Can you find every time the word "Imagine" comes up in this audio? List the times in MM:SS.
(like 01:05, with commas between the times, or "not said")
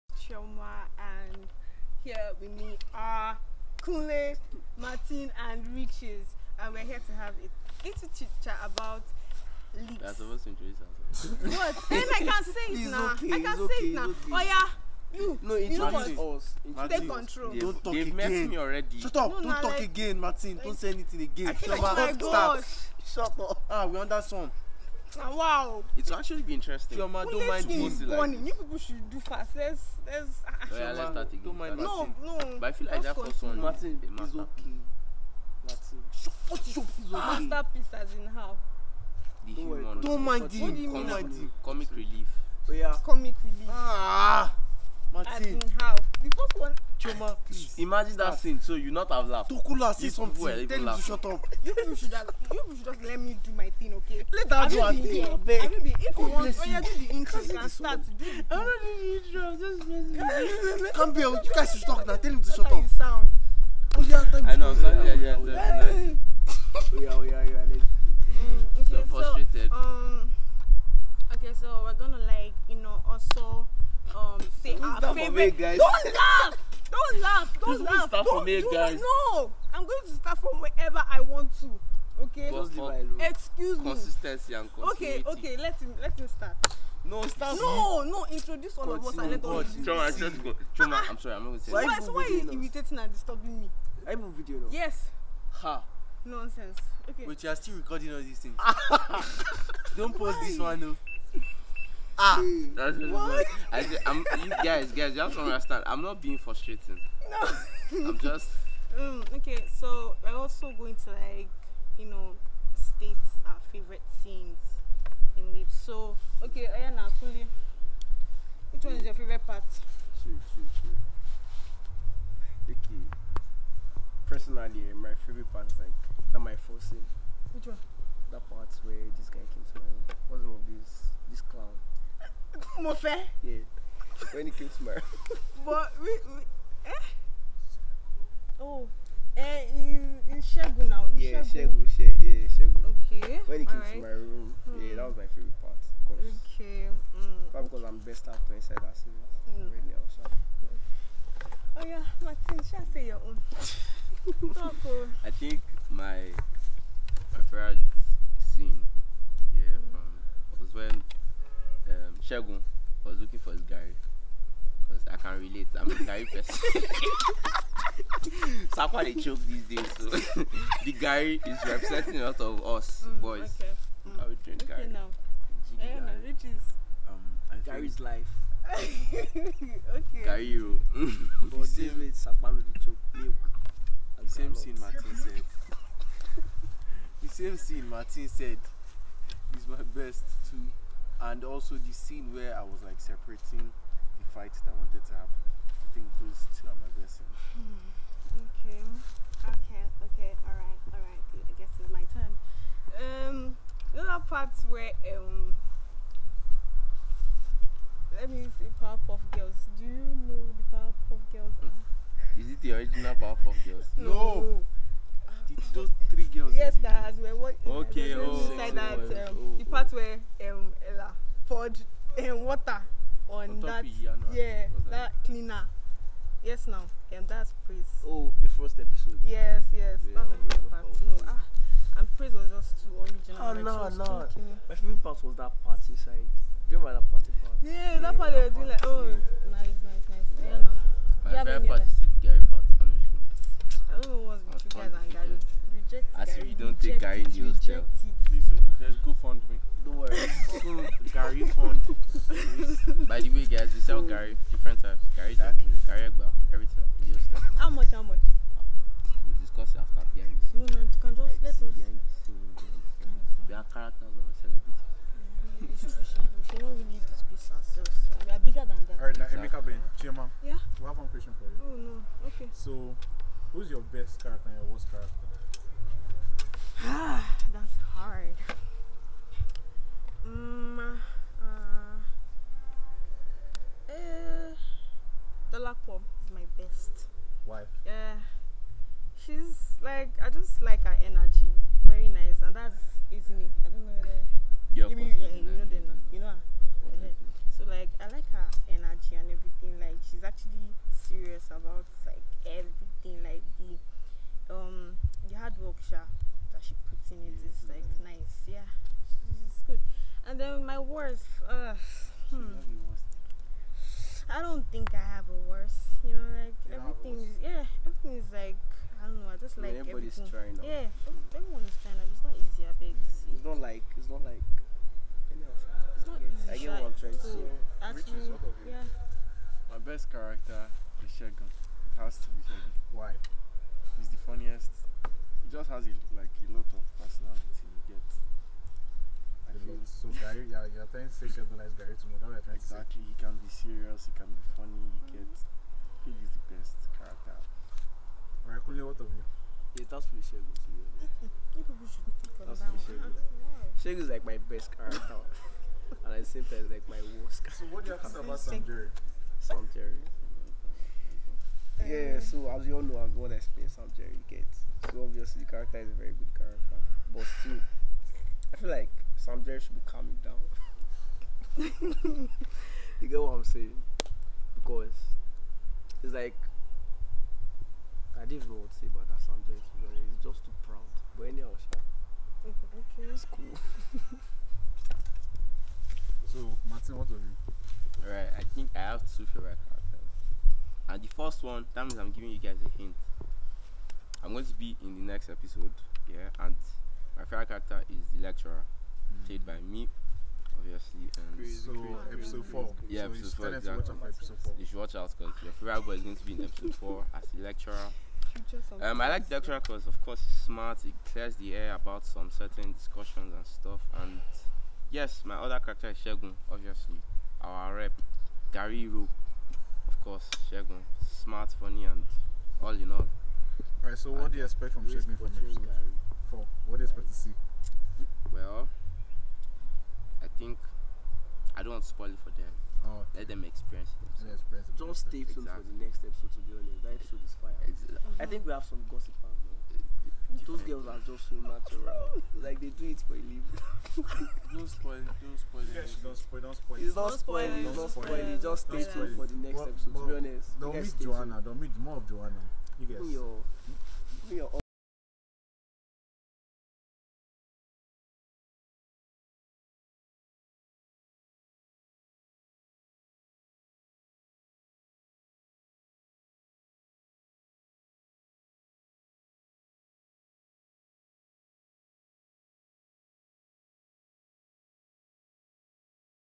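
00:47.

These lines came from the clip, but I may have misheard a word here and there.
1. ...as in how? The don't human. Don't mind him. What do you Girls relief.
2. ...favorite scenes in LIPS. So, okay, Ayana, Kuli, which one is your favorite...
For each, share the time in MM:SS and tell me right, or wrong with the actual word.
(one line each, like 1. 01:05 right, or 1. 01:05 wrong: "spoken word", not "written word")
1. 00:37 wrong: "Comic", not "Girls"
2. 01:53 right.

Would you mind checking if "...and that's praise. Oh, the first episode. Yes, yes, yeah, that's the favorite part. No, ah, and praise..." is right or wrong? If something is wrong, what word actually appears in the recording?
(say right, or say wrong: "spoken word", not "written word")
right.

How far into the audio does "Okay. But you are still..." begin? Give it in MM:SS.
01:37.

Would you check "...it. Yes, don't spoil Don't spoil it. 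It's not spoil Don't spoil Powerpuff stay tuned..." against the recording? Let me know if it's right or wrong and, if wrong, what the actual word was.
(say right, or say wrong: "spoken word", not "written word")
wrong: "Just", not "Powerpuff".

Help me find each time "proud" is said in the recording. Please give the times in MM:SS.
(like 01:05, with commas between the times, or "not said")
06:20.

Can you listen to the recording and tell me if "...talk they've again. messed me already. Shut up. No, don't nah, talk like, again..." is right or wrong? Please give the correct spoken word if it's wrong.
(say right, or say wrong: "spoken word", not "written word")
right.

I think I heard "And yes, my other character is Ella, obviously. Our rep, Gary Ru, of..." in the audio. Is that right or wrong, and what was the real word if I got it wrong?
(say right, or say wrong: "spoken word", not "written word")
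wrong: "Shegun", not "Ella".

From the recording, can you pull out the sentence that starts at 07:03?
Alright, so what do you expect from Shegun from episode four?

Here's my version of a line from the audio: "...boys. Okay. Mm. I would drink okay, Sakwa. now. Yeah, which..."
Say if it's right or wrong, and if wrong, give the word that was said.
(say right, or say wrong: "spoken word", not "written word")
wrong: "Gary", not "Sakwa".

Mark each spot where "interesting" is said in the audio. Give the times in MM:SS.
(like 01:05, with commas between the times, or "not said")
00:26.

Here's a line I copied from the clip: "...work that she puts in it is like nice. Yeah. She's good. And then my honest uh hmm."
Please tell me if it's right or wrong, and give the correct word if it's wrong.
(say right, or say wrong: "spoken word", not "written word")
wrong: "worst", not "honest".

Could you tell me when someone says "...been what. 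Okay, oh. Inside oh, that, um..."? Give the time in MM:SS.
03:37.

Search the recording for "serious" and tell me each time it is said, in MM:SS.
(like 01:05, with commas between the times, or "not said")
05:00, 05:43.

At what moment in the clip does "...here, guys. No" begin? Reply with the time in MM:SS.
01:18.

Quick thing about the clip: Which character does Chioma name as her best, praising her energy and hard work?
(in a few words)
Bakpo.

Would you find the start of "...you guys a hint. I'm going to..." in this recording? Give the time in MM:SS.
06:32.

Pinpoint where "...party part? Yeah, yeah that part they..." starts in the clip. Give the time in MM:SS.
03:57.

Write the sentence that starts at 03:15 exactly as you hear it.
I think those two are my blessings.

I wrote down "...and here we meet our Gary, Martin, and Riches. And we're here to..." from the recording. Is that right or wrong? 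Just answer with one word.
wrong.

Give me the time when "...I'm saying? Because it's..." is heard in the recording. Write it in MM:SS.
06:13.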